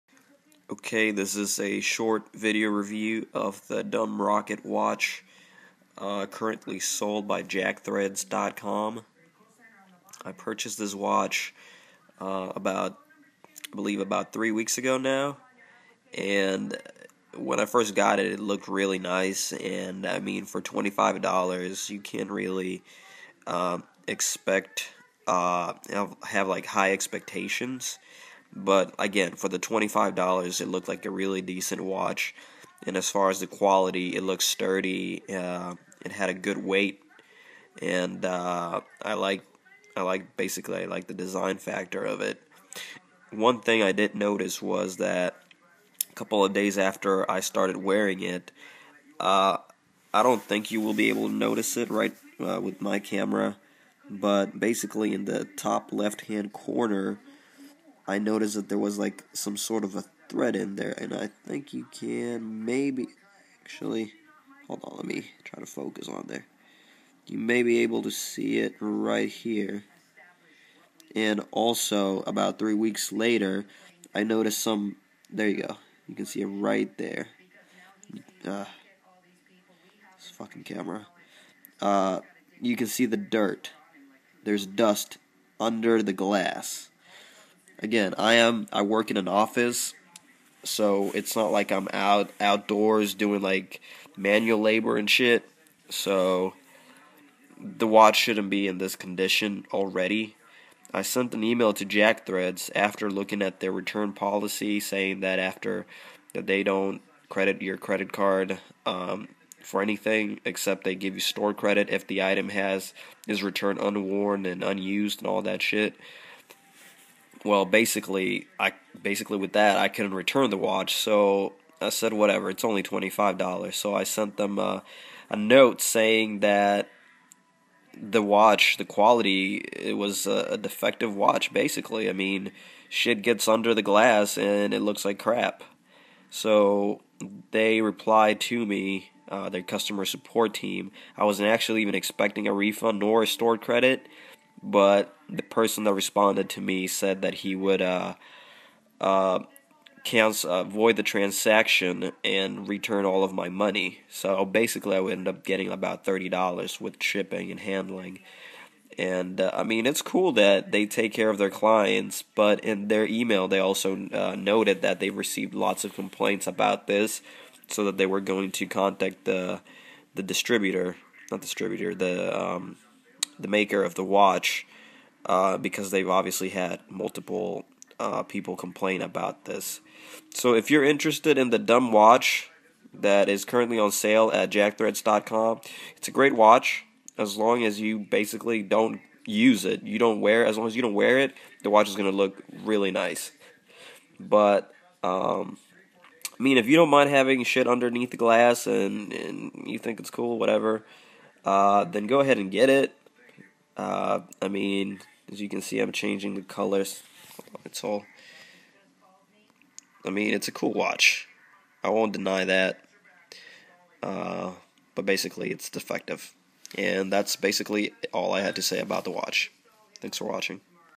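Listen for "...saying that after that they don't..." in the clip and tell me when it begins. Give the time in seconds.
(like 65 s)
104 s.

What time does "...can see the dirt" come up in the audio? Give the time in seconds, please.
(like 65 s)
82 s.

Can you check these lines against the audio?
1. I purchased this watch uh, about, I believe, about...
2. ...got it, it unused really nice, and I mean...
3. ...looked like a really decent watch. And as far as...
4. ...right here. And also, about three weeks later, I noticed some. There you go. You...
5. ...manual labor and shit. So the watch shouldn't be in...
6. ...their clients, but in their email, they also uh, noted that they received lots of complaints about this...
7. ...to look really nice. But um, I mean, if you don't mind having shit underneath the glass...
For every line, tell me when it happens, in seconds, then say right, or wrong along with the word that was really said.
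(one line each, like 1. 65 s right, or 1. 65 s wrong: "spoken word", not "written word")
1. 10 s right
2. 17 s wrong: "looked", not "unused"
3. 30 s right
4. 68 s right
5. 94 s right
6. 161 s right
7. 192 s right.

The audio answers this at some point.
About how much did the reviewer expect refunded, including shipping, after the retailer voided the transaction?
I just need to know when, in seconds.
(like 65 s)
156 s.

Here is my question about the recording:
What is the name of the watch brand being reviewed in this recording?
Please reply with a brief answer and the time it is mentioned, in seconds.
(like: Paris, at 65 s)
Dumb Rocket, at 3 s.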